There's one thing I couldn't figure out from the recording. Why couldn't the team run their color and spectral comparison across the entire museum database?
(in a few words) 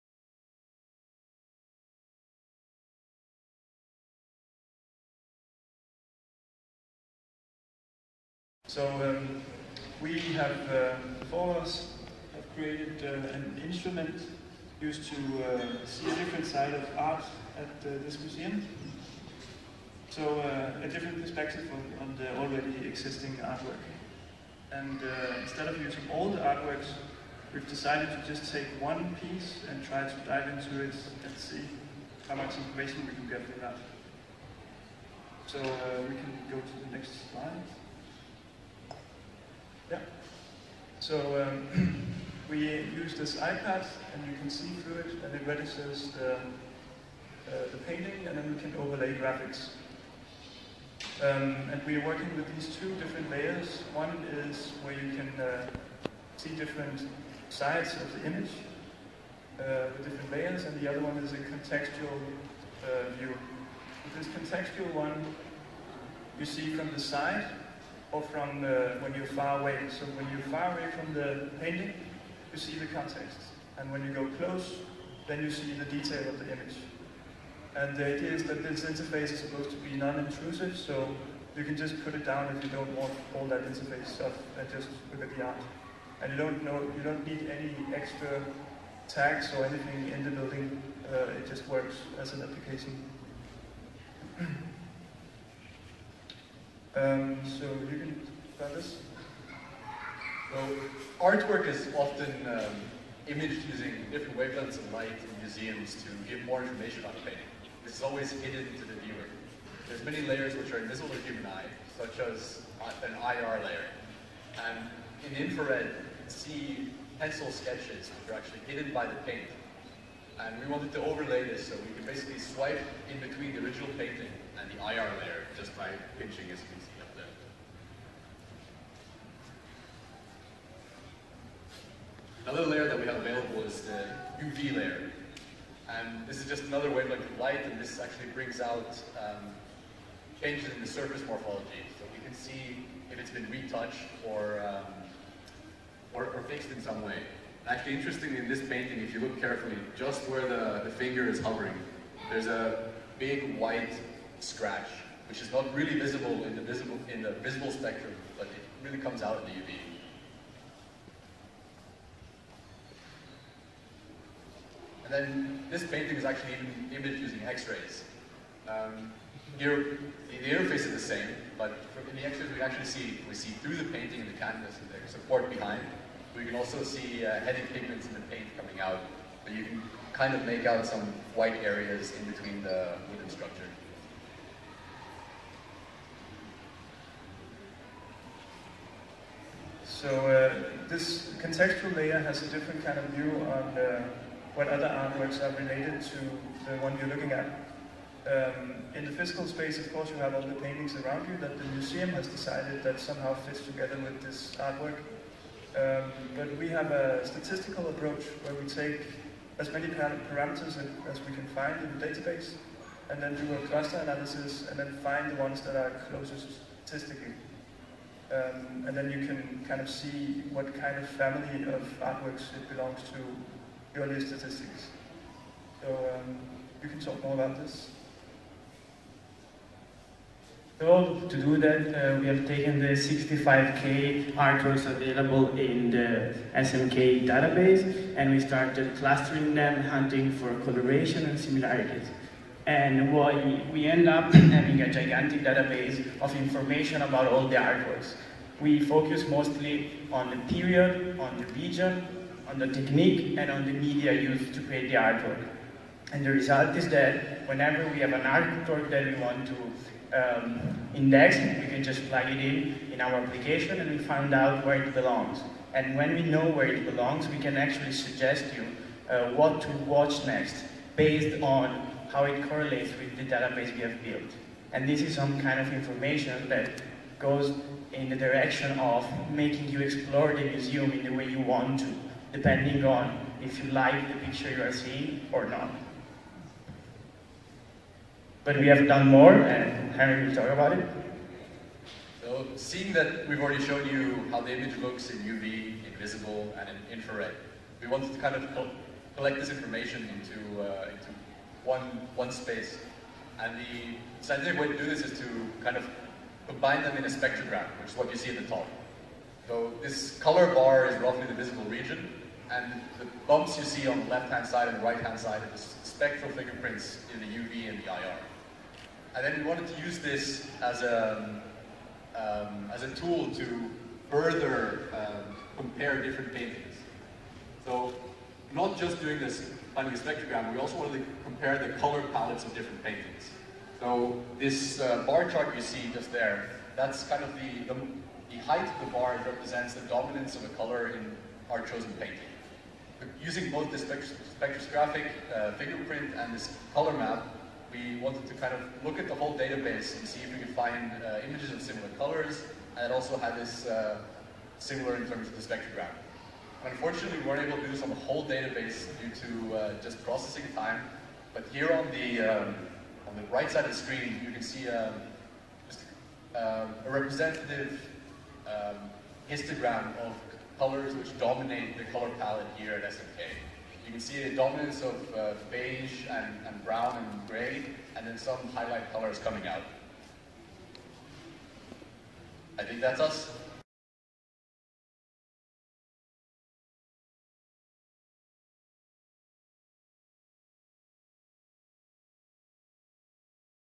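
Processing time.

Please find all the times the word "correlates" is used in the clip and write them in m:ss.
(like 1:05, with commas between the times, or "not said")
4:32.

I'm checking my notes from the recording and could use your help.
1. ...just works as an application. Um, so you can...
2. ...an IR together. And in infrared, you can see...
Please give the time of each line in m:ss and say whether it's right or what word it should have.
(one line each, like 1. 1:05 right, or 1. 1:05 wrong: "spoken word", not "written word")
1. 1:31 right
2. 1:53 wrong: "layer", not "together".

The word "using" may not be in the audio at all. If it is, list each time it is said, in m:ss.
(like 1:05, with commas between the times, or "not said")
0:25, 1:43, 2:47, 5:43.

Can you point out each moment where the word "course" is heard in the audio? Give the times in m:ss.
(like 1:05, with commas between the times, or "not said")
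3:19.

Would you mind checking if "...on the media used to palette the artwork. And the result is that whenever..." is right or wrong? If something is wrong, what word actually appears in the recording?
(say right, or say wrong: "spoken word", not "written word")
wrong: "create", not "palette".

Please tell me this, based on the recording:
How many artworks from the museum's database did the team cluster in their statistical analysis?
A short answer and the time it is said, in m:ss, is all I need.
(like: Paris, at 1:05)
65,000, at 3:52.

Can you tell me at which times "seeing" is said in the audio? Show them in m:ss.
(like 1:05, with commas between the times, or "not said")
4:44, 4:52.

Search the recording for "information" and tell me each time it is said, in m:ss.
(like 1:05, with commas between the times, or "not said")
0:32, 1:46, 4:06, 4:35, 4:59.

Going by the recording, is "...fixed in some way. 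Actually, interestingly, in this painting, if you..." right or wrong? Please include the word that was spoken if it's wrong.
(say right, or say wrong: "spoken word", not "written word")
right.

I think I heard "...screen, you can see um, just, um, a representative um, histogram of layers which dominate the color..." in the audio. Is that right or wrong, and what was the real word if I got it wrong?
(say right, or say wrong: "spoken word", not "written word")
wrong: "colors", not "layers".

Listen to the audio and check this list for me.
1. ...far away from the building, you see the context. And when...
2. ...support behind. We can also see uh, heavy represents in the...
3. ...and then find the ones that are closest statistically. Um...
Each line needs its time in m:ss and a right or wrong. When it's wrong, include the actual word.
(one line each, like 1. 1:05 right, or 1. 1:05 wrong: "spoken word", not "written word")
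1. 1:10 wrong: "painting", not "building"
2. 2:55 wrong: "pigments", not "represents"
3. 3:34 right.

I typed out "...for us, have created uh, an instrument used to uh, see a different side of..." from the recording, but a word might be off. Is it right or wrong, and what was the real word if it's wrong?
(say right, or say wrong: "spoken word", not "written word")
right.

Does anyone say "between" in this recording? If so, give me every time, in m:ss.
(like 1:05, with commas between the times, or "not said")
2:03, 3:02.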